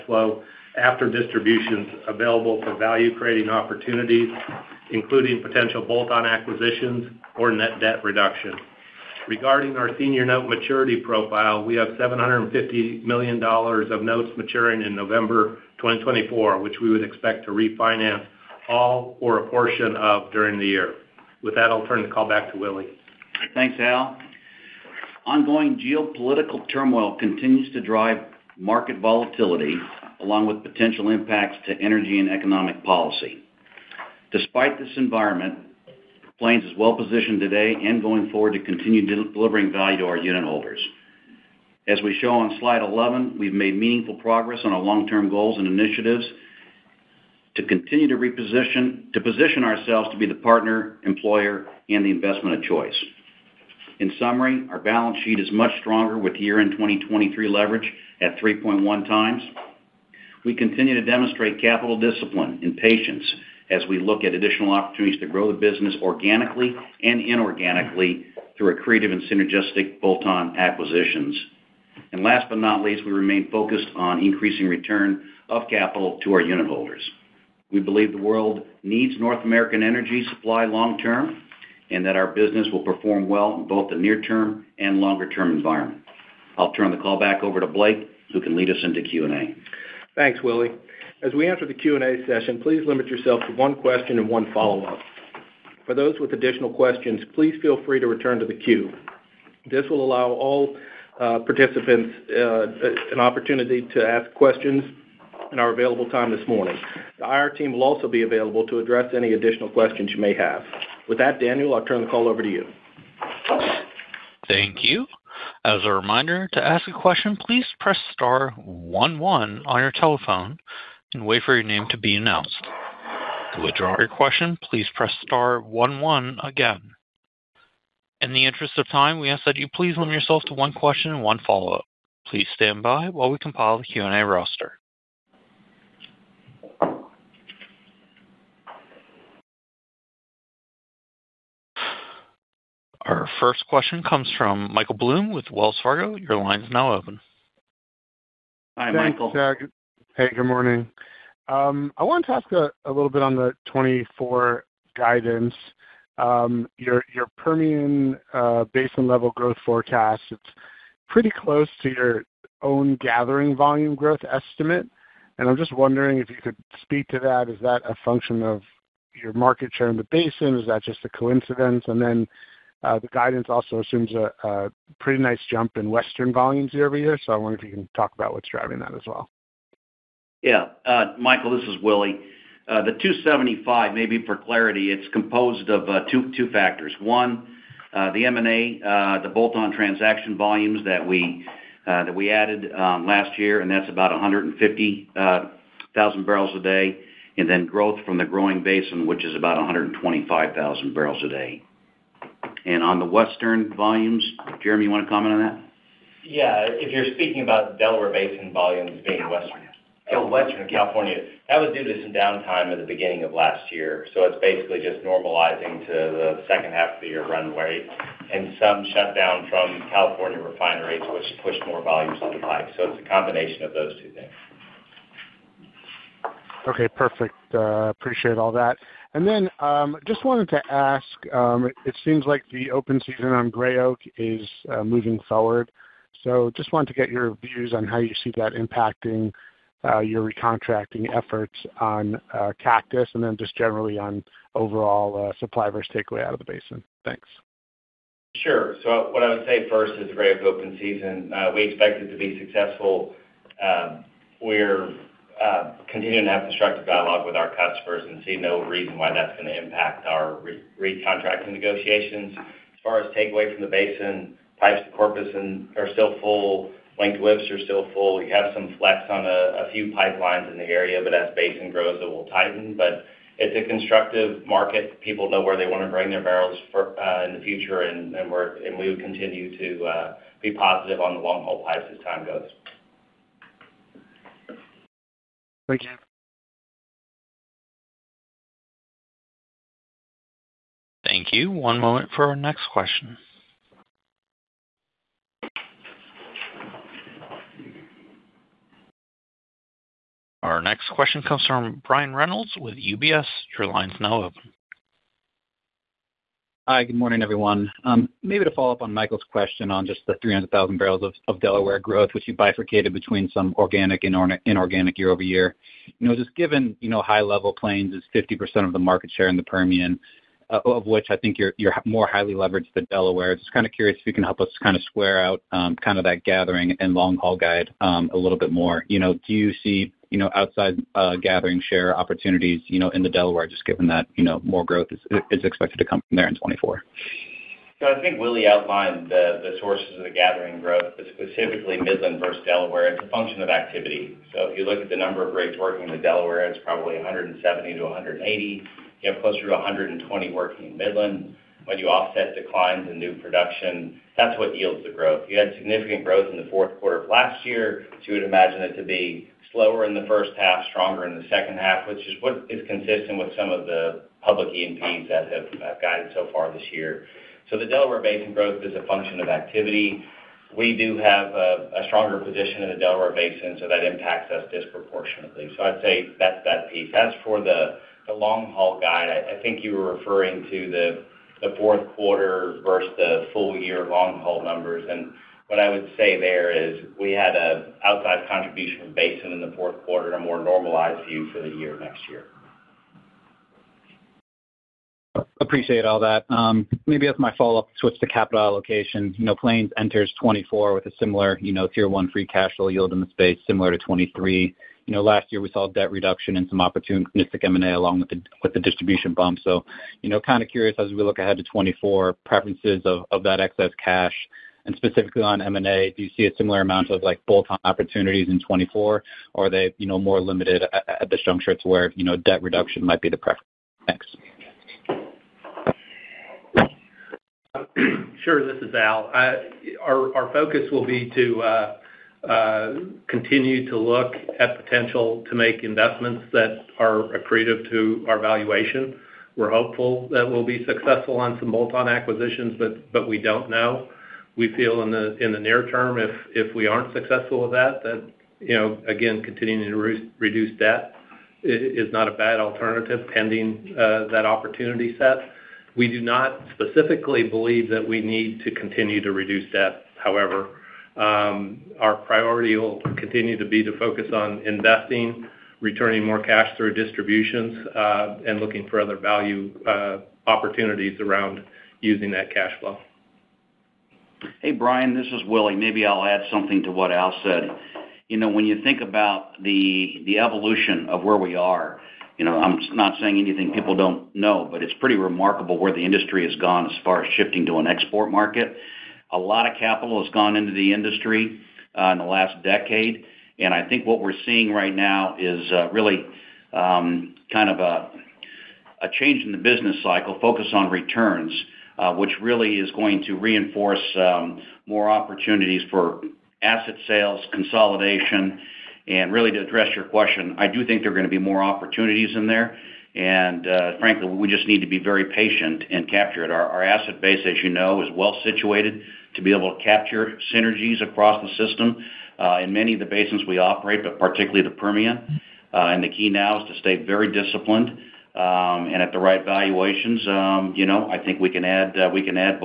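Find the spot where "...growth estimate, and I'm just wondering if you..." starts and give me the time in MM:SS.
02:43.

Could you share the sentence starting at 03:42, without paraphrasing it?
So It's a combination of those two things.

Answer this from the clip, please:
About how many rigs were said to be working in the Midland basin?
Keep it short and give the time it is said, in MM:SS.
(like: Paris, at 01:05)
120, at 05:49.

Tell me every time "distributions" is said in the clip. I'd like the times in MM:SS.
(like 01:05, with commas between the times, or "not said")
00:01, 06:48, 07:46.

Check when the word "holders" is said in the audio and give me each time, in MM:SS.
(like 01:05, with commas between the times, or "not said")
00:40, 01:16.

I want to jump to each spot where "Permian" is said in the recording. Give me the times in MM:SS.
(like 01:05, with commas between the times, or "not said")
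02:37, 05:19, 08:44.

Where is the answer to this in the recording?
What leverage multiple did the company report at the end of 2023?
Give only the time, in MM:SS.
00:58.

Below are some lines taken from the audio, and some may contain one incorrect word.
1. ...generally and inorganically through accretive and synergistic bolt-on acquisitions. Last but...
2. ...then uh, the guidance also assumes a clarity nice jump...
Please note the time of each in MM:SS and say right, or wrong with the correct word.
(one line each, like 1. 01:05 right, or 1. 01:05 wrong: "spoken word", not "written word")
1. 01:06 wrong: "organically", not "generally"
2. 02:52 wrong: "pretty", not "clarity".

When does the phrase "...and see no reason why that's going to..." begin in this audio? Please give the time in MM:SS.
04:18.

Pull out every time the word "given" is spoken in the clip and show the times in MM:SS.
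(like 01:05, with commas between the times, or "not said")
05:16, 05:33.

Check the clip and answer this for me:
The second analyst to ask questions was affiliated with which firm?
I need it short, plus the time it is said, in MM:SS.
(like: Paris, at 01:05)
UBS, at 05:02.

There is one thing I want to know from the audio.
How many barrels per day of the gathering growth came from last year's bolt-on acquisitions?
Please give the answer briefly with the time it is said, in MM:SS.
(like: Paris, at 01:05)
150,000 barrels a day, at 03:14.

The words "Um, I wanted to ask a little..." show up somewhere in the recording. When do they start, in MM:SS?
02:31.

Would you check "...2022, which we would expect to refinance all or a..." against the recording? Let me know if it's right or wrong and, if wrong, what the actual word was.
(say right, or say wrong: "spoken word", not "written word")
wrong: "2024", not "2022".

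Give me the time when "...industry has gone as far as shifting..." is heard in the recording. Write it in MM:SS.
08:05.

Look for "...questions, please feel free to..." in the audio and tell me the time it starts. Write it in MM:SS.
01:36.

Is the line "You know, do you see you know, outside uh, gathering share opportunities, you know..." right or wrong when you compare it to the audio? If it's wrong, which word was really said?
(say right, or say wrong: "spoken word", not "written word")
right.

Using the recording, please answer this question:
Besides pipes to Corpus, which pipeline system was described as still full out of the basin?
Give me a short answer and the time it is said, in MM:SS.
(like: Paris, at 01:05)
Wink to Webster, at 04:26.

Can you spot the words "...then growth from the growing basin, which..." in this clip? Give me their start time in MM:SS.
03:17.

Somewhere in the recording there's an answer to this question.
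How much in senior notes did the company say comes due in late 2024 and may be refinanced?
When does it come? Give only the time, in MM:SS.
00:11.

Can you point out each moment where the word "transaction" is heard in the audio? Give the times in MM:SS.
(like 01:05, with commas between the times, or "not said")
03:09.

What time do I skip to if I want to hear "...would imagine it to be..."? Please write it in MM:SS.
05:58.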